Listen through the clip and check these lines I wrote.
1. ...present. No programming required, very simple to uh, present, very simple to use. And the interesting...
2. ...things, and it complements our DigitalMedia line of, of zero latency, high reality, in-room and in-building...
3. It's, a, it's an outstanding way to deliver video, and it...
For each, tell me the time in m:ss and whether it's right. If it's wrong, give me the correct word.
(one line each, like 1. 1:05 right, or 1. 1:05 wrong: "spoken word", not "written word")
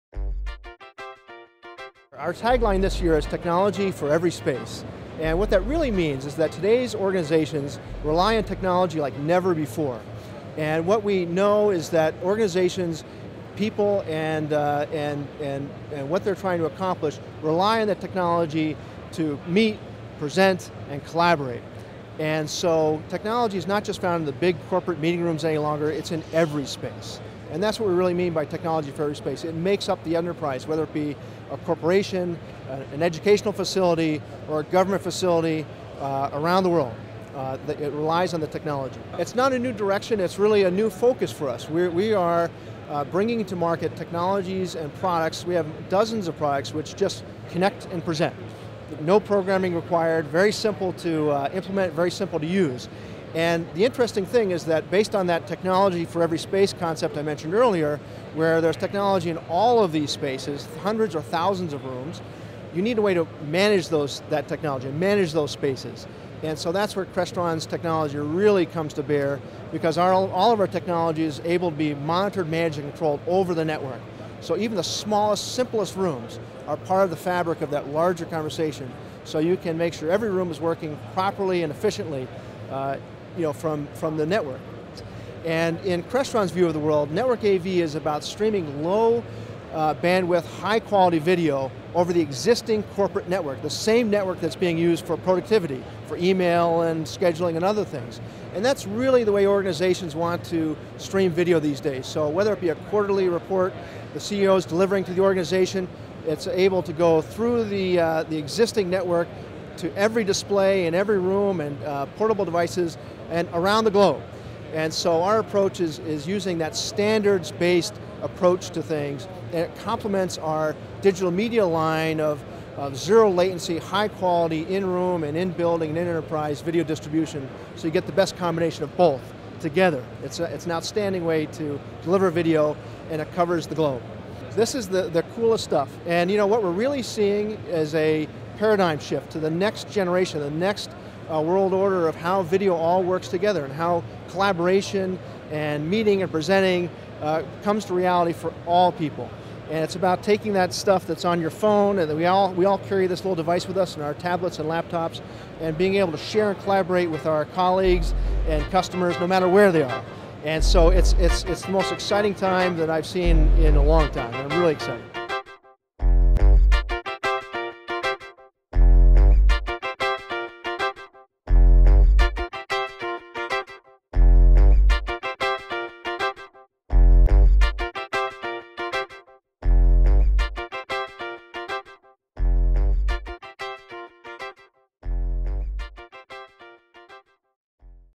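1. 0:48 wrong: "implement", not "present"
2. 1:58 wrong: "quality", not "reality"
3. 2:10 right.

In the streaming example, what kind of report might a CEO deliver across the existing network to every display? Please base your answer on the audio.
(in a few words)
Quarterly report.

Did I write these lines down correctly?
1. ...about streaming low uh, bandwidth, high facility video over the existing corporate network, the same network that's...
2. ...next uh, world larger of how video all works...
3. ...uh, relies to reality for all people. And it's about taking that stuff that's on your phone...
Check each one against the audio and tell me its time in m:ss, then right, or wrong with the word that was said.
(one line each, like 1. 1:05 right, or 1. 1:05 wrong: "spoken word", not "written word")
1. 1:27 wrong: "quality", not "facility"
2. 2:20 wrong: "order", not "larger"
3. 2:27 wrong: "comes", not "relies".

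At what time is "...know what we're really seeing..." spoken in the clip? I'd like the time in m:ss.
2:16.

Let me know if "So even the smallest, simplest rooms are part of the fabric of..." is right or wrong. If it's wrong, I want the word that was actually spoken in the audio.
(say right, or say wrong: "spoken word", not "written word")
right.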